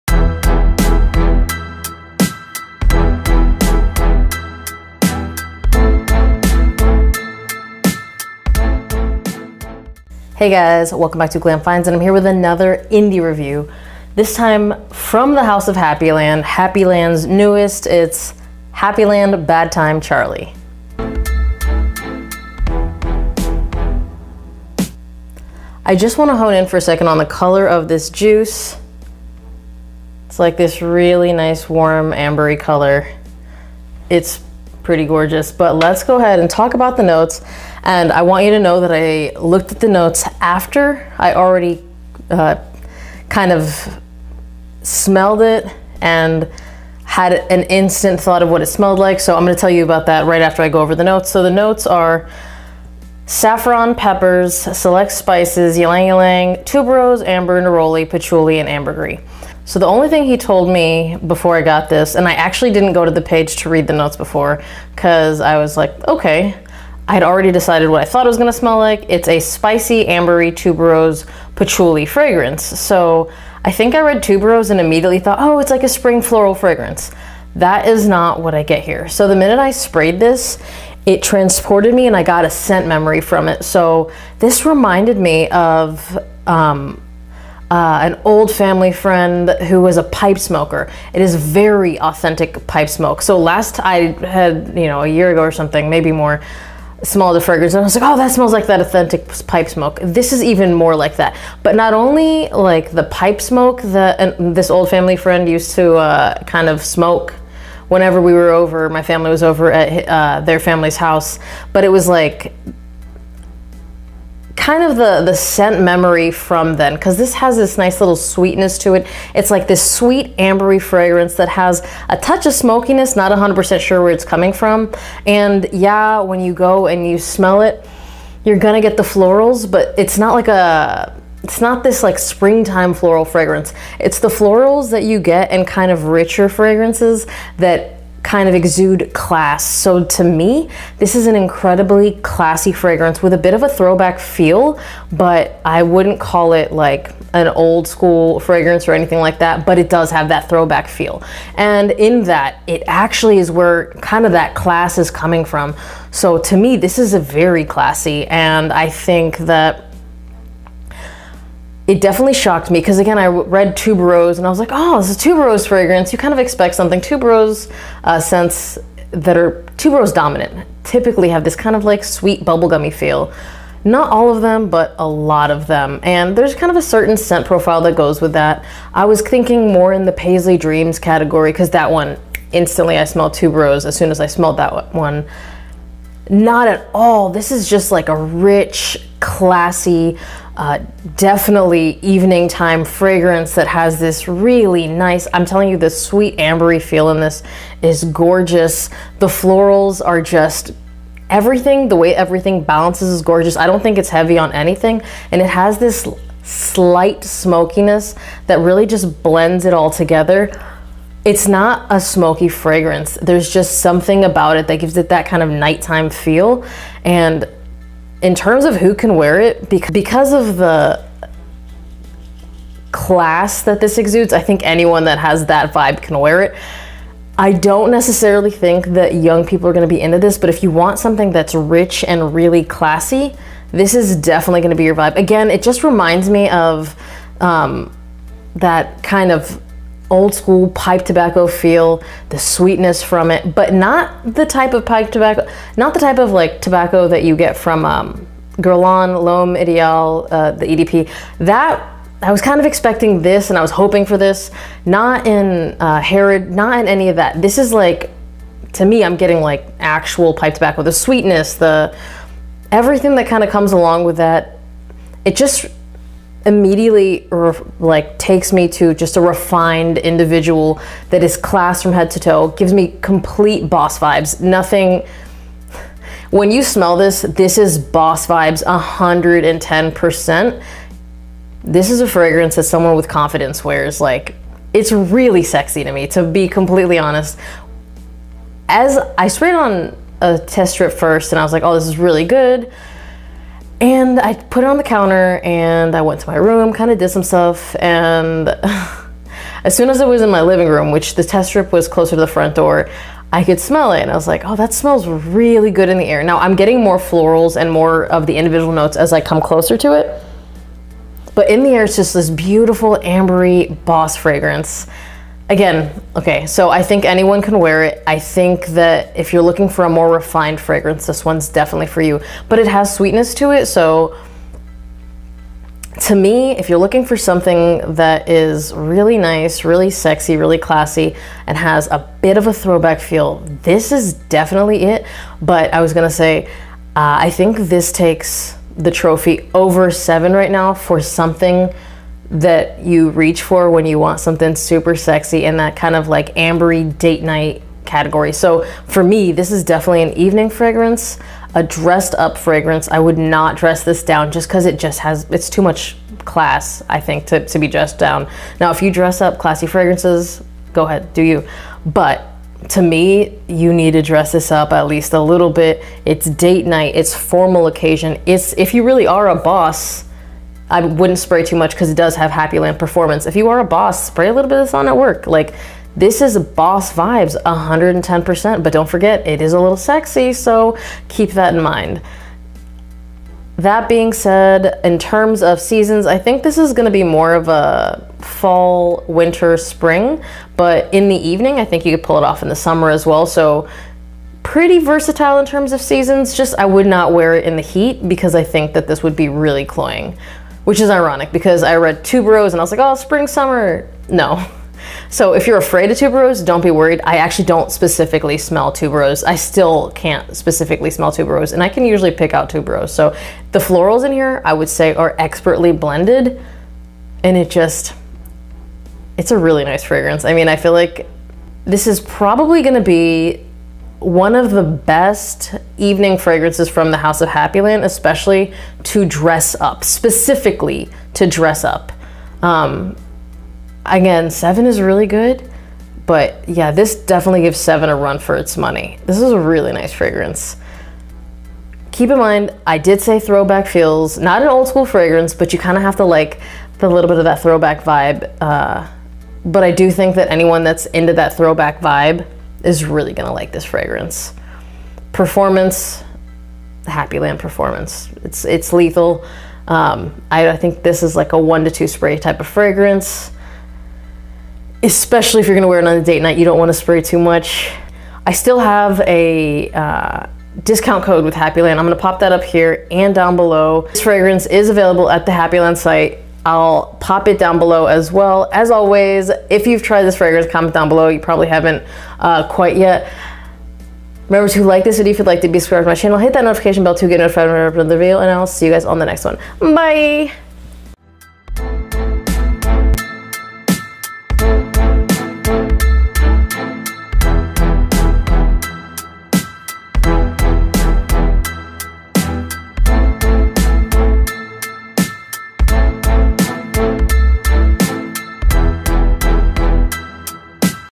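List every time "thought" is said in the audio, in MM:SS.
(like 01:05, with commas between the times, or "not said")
00:48, 01:08, 01:15.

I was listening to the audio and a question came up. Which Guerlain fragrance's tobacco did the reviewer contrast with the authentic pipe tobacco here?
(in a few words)
L'Homme Ideal.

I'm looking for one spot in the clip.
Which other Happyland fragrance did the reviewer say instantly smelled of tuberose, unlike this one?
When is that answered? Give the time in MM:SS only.
03:00.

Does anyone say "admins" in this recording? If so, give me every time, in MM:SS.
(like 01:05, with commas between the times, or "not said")
not said.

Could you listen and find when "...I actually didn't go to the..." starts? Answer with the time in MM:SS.
01:02.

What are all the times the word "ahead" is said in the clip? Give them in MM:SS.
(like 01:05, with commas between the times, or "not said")
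00:36, 06:00.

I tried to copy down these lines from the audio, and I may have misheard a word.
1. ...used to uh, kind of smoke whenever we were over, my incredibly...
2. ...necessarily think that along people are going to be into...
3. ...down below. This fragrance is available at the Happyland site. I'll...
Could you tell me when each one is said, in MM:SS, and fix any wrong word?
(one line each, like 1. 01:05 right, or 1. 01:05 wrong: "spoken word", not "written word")
1. 01:45 wrong: "family", not "incredibly"
2. 03:47 wrong: "young", not "along"
3. 07:53 right.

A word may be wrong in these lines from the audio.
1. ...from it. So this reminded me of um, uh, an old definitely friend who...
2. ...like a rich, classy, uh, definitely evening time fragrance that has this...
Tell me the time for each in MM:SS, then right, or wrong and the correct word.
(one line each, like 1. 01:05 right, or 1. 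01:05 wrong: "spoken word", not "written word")
1. 01:23 wrong: "family", not "definitely"
2. 03:07 right.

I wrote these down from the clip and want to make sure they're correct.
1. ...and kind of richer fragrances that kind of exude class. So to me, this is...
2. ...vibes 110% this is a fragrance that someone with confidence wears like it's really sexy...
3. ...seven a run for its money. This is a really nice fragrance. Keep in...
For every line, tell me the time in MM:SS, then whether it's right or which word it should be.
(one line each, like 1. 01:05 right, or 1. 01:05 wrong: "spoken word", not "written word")
1. 02:15 right
2. 04:38 right
3. 07:17 right.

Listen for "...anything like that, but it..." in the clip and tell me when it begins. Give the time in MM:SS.
02:28.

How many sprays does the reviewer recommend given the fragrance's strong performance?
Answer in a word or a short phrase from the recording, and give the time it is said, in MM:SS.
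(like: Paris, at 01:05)
1 to 2, at 07:41.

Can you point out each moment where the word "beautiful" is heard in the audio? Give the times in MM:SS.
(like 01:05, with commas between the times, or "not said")
05:12.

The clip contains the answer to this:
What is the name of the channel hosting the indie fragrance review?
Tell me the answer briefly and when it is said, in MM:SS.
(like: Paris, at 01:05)
Glam Finds, at 00:11.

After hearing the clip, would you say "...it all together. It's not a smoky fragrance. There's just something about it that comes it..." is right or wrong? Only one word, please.
wrong.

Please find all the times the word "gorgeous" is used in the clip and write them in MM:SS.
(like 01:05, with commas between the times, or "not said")
00:35, 03:18, 03:23.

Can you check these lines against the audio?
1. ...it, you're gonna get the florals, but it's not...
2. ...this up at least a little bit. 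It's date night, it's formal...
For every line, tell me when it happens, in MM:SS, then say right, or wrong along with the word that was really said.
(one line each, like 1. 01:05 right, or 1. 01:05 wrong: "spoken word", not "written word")
1. 02:07 right
2. 06:04 right.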